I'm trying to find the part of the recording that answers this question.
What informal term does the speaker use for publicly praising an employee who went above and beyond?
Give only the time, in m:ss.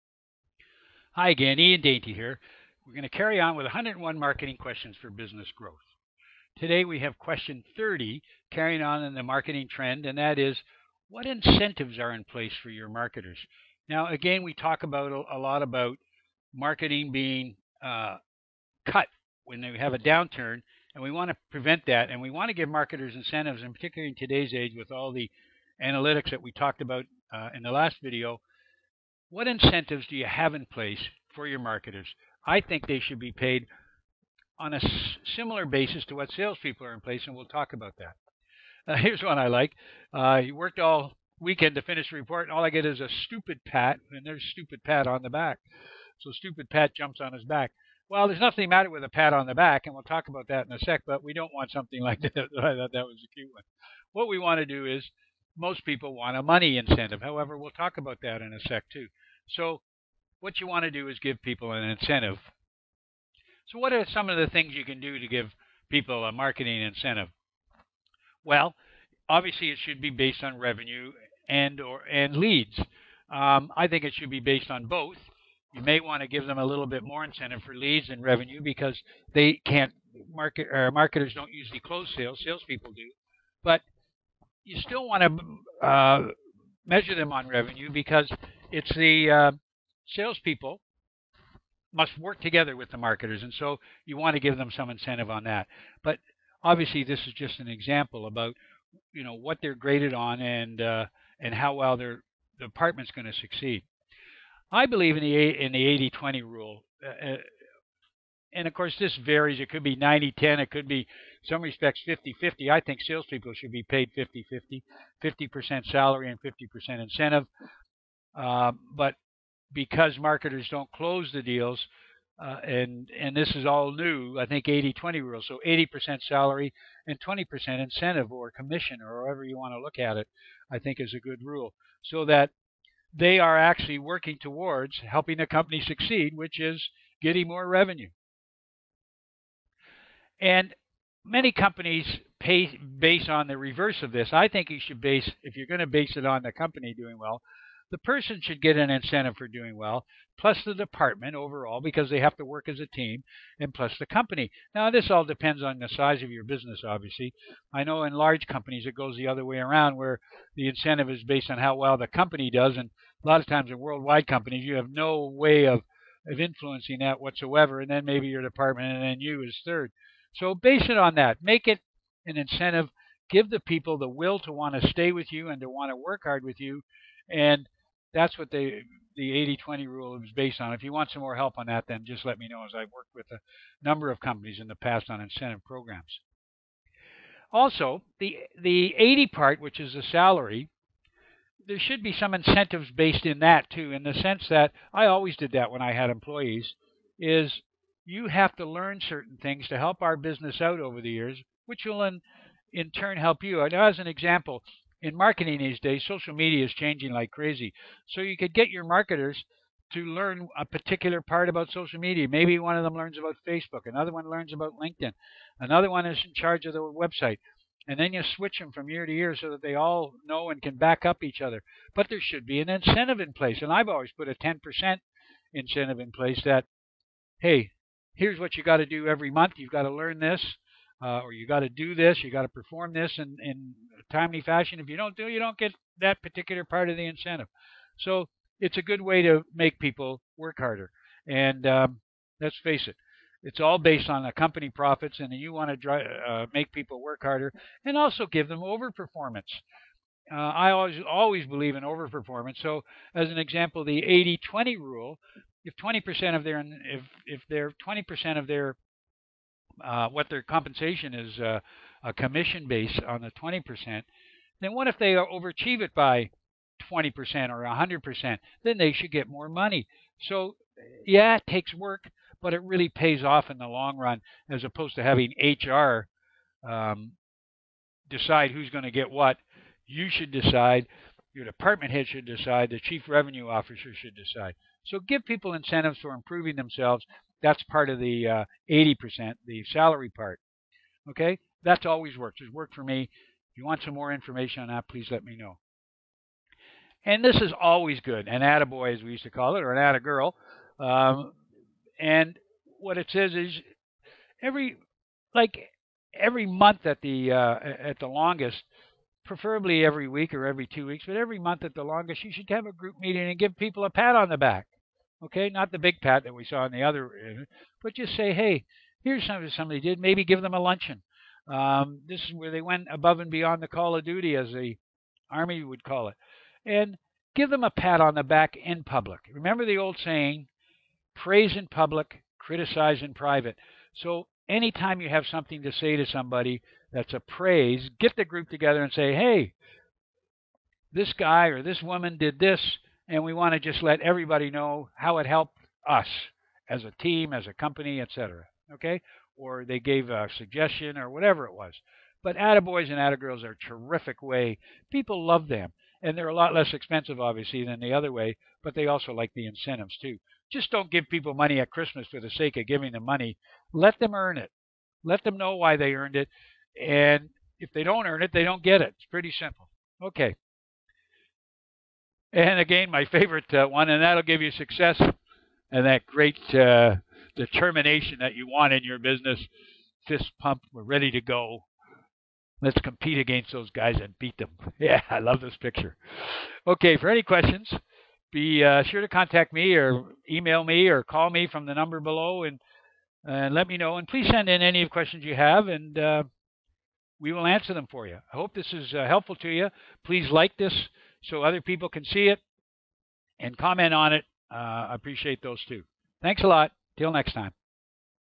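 4:58.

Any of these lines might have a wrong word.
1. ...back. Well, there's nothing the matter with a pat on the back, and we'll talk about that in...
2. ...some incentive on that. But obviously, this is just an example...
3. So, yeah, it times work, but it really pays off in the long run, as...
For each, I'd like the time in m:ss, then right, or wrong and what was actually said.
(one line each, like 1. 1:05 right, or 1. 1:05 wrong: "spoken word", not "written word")
1. 0:47 right
2. 1:34 right
3. 4:30 wrong: "takes", not "times".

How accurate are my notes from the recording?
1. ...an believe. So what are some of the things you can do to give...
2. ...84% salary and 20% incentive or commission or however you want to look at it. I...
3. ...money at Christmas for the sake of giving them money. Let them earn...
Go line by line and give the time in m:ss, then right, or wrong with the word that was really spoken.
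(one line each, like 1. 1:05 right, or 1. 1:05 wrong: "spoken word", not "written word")
1. 1:01 wrong: "incentive", not "believe"
2. 2:05 wrong: "80", not "84"
3. 6:01 right.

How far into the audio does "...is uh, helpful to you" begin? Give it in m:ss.
6:38.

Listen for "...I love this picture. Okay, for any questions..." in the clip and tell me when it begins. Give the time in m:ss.
6:25.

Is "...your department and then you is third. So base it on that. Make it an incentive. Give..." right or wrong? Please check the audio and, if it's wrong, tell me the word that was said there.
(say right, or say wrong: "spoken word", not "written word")
right.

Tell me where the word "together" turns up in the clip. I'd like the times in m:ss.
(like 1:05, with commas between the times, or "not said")
1:32, 5:38.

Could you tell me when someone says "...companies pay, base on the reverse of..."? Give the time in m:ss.
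2:21.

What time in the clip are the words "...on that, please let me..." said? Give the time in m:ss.
4:54.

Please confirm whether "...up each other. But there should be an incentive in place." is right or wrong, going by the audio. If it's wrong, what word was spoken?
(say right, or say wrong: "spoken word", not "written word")
right.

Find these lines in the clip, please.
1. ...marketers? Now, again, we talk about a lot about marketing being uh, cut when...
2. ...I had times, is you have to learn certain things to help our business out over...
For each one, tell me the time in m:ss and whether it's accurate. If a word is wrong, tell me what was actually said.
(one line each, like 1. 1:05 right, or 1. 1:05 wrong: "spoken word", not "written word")
1. 0:12 right
2. 3:15 wrong: "employees", not "times".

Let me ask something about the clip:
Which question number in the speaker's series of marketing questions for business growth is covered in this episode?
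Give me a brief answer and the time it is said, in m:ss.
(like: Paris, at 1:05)
30, at 0:07.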